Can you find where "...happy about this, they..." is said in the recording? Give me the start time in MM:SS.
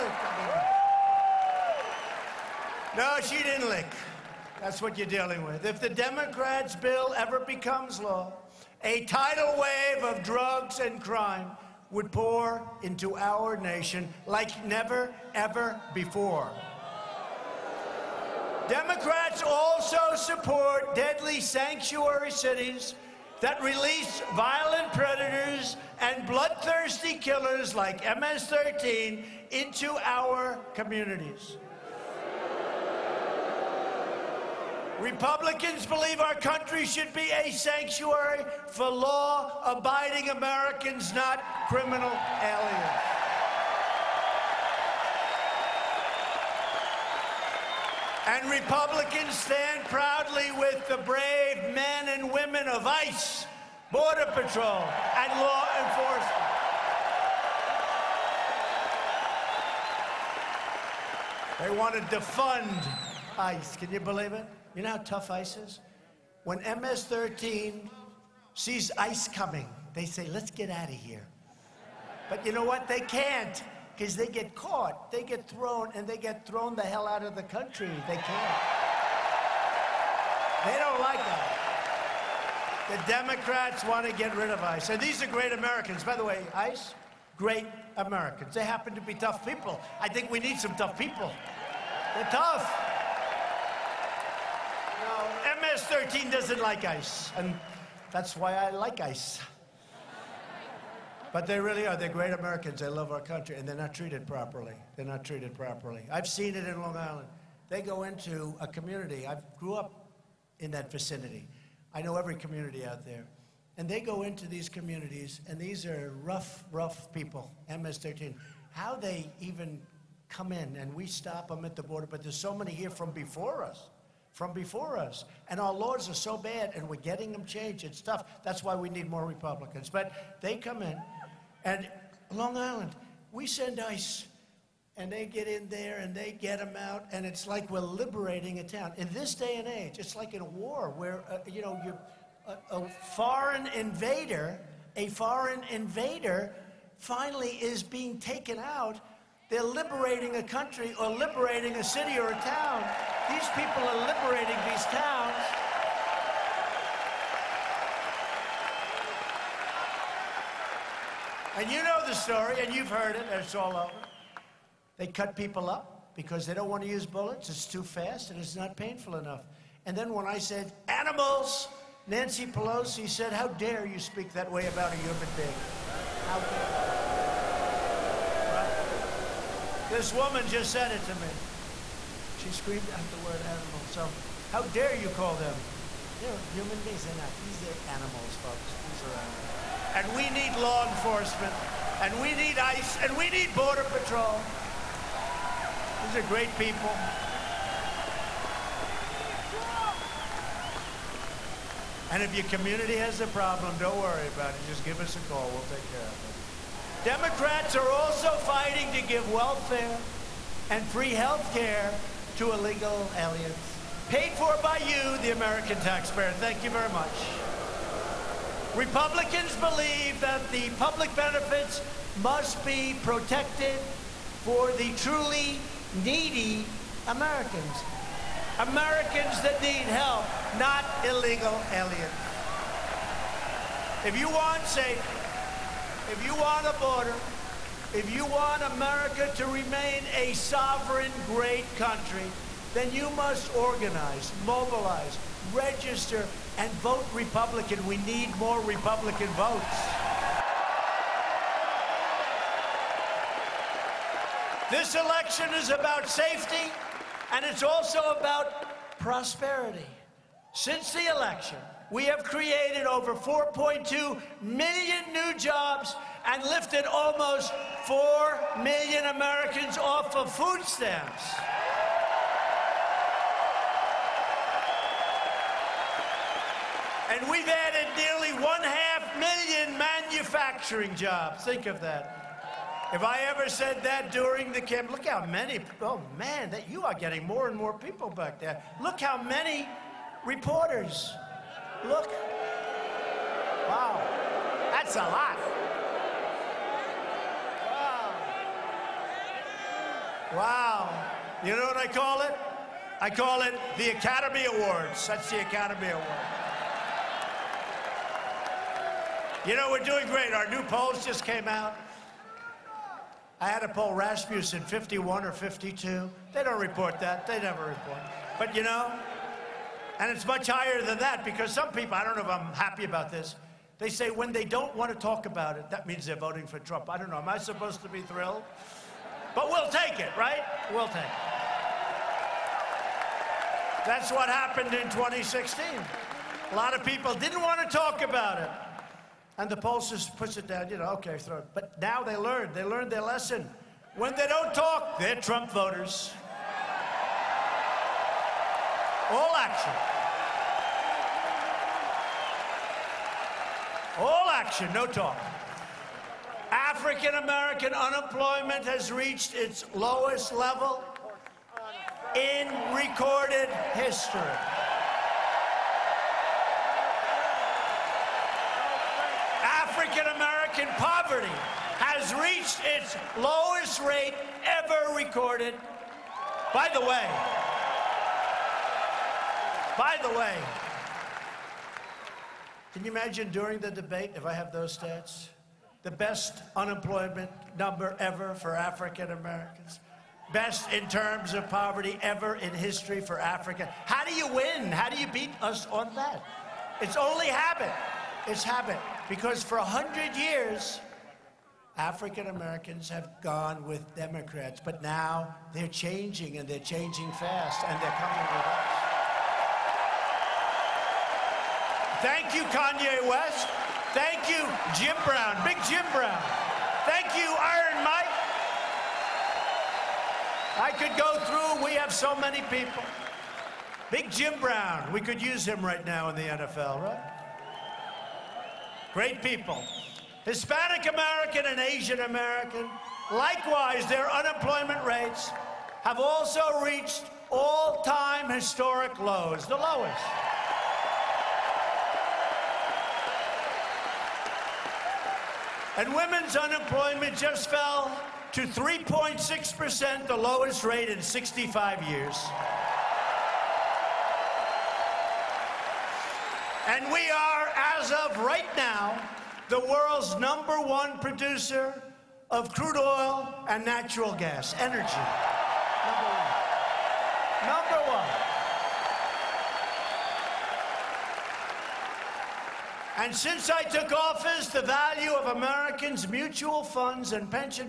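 05:22.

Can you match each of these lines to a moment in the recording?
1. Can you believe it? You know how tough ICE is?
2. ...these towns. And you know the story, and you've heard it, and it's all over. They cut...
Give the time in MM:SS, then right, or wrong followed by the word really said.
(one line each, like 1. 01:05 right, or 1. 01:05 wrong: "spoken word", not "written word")
1. 01:03 right
2. 02:34 right.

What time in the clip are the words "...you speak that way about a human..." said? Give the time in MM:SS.
02:53.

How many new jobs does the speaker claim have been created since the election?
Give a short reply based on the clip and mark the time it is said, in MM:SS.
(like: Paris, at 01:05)
4.2 million, at 04:23.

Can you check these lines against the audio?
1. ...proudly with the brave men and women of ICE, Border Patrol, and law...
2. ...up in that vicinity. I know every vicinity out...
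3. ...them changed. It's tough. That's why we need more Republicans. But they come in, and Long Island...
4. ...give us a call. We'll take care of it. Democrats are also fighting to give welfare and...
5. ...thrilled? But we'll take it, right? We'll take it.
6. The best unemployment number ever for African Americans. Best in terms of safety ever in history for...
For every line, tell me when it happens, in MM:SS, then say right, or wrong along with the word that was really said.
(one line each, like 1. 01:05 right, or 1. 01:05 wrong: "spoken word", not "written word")
1. 00:49 right
2. 01:49 wrong: "community", not "vicinity"
3. 02:07 right
4. 03:24 right
5. 05:28 right
6. 06:25 wrong: "poverty", not "safety".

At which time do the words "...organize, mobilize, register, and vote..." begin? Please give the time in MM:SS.
04:03.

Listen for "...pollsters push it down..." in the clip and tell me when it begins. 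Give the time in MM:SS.
05:39.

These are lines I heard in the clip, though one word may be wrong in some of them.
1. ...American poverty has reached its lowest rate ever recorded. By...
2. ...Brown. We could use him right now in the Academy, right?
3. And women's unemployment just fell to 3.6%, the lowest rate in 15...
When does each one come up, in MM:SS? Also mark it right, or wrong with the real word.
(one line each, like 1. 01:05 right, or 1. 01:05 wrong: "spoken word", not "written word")
1. 06:10 right
2. 07:04 wrong: "NFL", not "Academy"
3. 07:25 wrong: "65", not "15".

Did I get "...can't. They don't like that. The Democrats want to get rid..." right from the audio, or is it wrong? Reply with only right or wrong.
right.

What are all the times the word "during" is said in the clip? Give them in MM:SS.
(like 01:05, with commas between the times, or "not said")
04:44, 06:23.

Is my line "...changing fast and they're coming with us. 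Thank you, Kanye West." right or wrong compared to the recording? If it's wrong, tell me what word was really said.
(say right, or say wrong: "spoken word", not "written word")
right.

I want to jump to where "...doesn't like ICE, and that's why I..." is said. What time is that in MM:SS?
01:36.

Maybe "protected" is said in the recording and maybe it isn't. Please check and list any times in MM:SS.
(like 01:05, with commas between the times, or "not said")
03:43.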